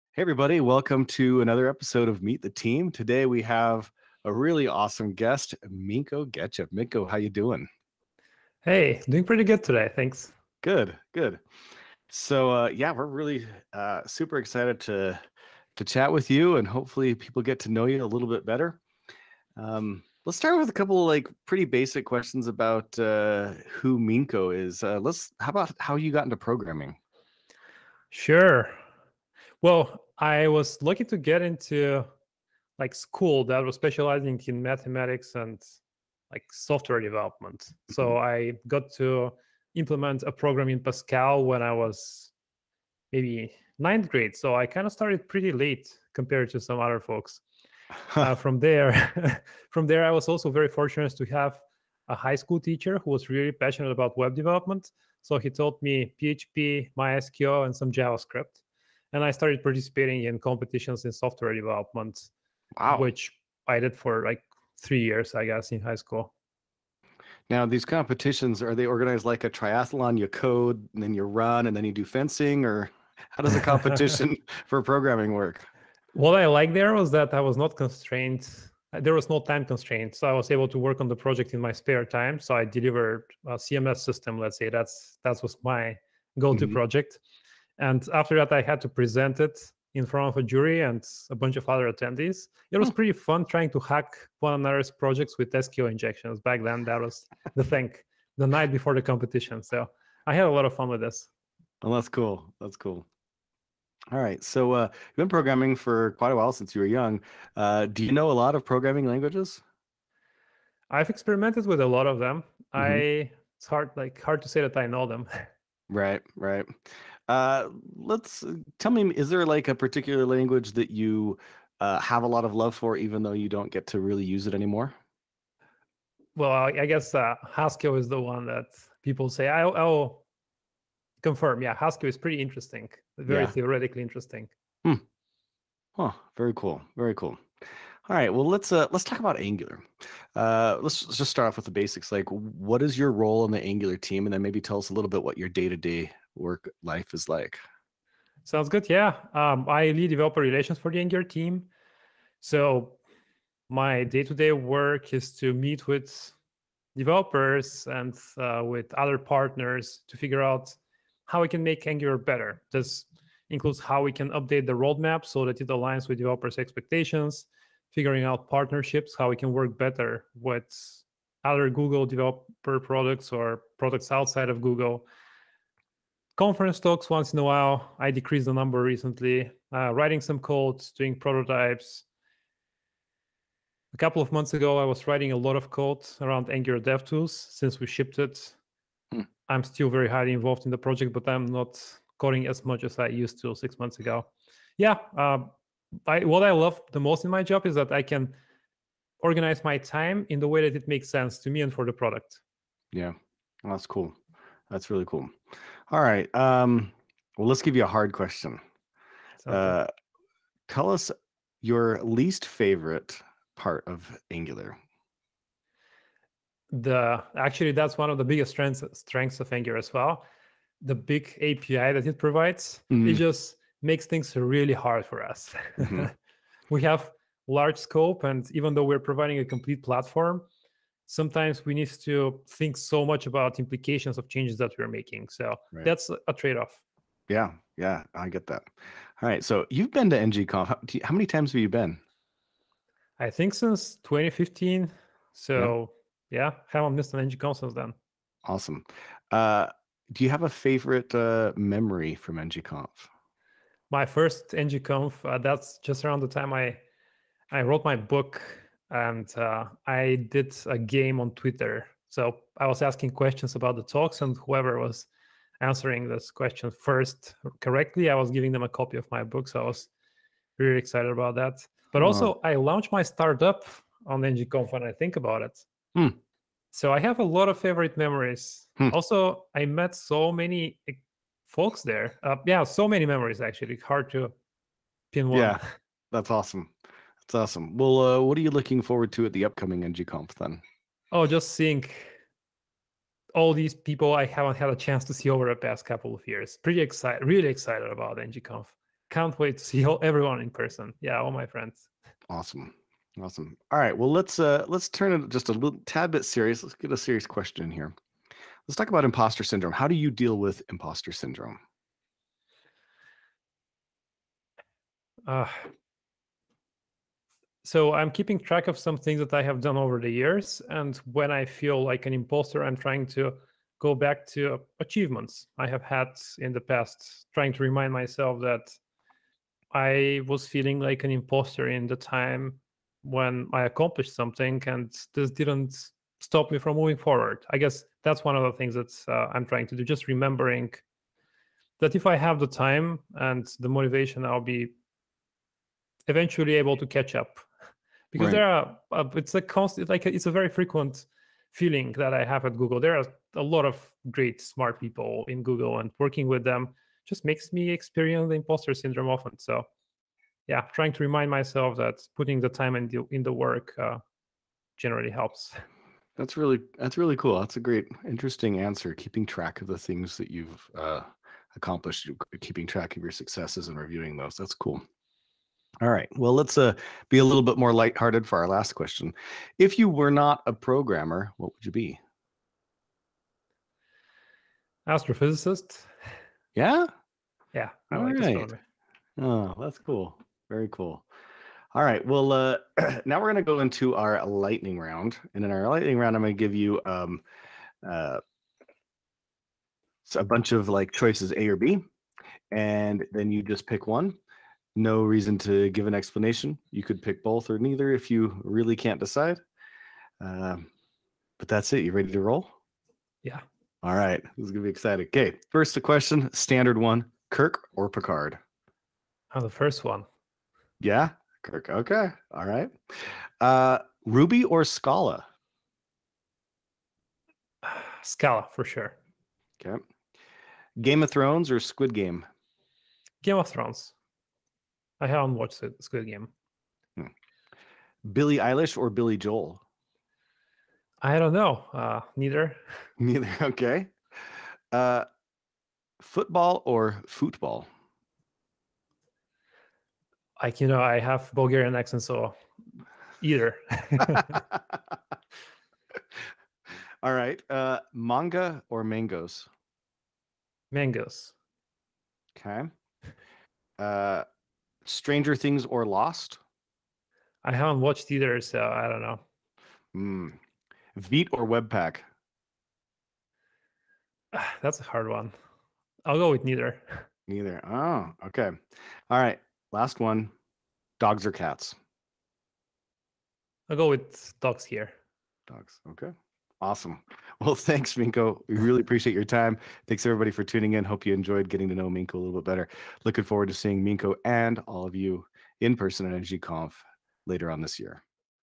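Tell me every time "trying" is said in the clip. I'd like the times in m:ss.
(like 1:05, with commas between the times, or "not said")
1:33, 5:22, 5:27, 5:39, 6:00.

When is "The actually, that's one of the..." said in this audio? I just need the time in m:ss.
3:36.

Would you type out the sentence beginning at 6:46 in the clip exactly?
You could pick both or neither if you really can't decide.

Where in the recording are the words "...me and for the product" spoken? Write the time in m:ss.
3:21.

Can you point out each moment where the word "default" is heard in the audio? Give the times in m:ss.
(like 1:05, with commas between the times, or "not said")
not said.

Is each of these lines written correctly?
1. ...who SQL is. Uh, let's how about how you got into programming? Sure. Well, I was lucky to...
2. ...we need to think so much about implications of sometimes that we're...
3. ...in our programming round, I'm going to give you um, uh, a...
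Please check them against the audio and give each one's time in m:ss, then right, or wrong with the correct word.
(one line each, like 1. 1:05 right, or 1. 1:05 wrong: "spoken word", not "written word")
1. 0:23 wrong: "Minko", not "SQL"
2. 3:51 wrong: "changes", not "sometimes"
3. 6:35 wrong: "lightning", not "programming".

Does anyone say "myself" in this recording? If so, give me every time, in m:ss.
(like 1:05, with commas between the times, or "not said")
5:27, 6:01.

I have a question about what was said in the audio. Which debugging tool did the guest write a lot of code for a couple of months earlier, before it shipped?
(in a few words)
Angular DevTools.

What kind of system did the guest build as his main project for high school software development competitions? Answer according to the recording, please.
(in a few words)
CMS.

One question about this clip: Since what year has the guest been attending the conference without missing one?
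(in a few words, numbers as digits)
2015.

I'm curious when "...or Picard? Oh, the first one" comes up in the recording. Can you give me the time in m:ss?
6:57.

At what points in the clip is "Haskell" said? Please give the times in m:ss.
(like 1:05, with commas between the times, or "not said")
2:07, 2:11.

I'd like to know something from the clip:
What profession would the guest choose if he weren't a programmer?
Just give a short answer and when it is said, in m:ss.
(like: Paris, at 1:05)
Astrophysicist, at 6:24.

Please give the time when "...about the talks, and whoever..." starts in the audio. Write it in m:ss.
4:23.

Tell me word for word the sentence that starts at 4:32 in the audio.
I launched my startup on NGConf when I think about it.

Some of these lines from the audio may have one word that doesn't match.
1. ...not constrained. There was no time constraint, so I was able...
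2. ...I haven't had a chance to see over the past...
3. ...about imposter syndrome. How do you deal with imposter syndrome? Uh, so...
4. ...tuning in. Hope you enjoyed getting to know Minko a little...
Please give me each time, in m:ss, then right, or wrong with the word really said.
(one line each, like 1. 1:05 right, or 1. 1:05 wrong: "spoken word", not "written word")
1. 1:17 right
2. 4:54 right
3. 5:08 right
4. 8:10 right.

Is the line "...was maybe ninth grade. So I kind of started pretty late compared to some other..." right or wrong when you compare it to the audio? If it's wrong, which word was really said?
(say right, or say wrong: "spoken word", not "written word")
right.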